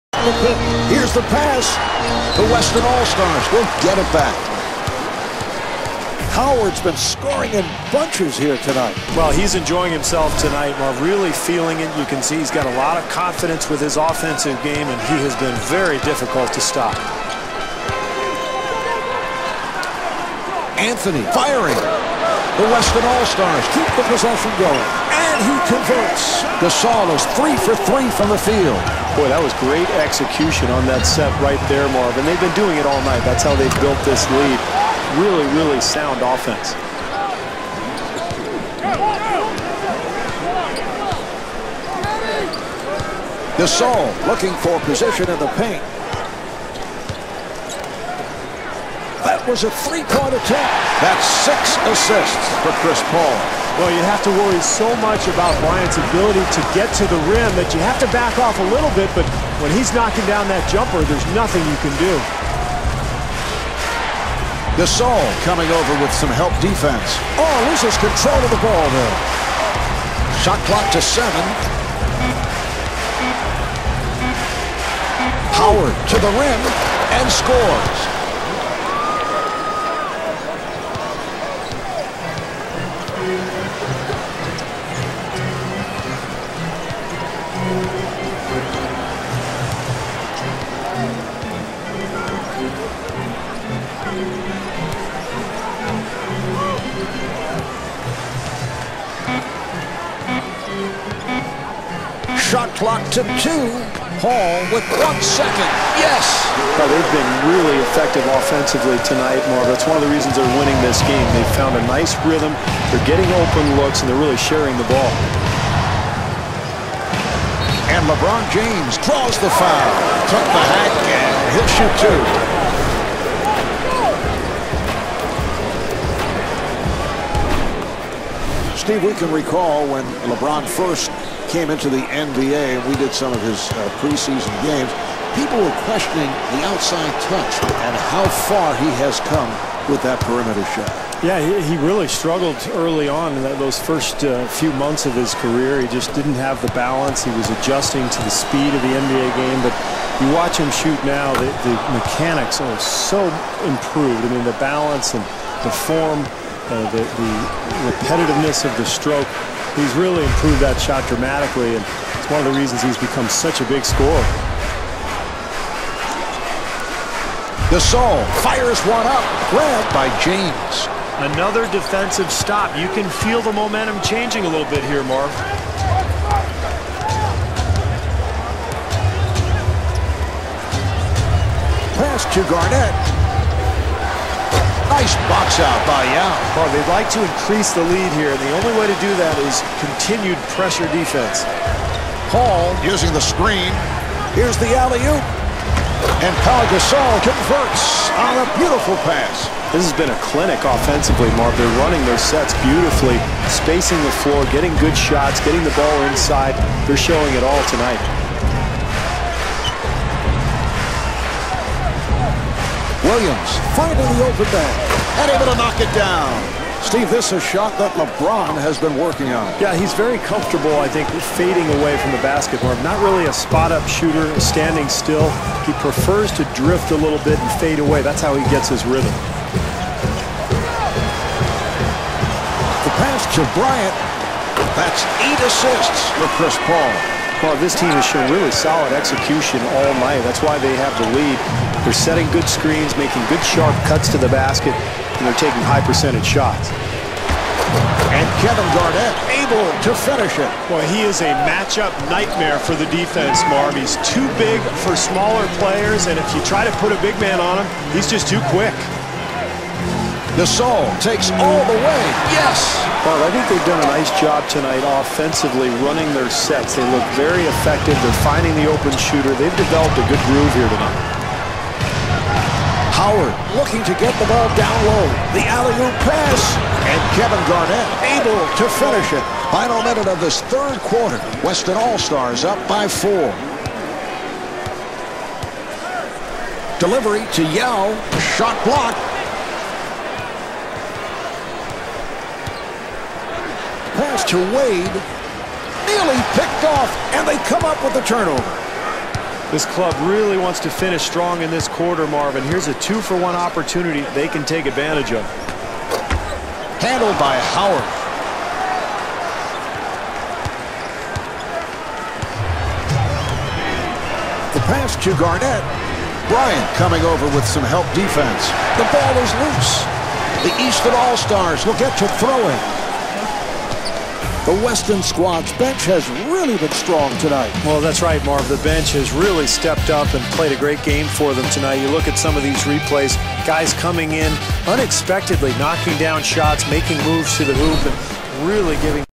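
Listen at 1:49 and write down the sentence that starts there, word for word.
That's one of the reasons they're winning this game.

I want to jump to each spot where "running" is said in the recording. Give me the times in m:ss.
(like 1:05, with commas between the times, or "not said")
3:21, 4:25.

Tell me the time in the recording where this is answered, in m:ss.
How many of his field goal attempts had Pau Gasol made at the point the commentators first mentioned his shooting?
0:27.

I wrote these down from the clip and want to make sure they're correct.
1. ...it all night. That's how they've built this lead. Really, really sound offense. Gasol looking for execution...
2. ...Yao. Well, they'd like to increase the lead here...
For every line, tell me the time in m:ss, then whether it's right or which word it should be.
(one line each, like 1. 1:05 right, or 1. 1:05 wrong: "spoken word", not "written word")
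1. 0:32 wrong: "position", not "execution"
2. 3:06 right.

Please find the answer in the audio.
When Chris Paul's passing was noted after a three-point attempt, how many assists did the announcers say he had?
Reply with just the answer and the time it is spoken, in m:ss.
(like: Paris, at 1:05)
6, at 0:51.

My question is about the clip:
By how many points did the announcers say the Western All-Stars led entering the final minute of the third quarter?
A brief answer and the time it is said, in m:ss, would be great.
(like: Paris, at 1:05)
4, at 4:42.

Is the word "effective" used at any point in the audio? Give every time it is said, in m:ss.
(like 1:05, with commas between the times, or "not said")
1:47, 4:27.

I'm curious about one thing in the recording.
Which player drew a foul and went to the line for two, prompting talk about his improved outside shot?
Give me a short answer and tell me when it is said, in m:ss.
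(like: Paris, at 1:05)
LeBron James, at 1:58.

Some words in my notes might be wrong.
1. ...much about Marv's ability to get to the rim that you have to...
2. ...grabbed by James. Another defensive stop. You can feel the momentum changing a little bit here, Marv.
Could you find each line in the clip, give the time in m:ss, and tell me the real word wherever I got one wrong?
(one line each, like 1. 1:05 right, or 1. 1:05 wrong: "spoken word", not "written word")
1. 0:55 wrong: "Bryant", not "Marv"
2. 2:49 right.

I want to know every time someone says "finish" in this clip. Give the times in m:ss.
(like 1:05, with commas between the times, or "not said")
4:10, 4:38, 5:00.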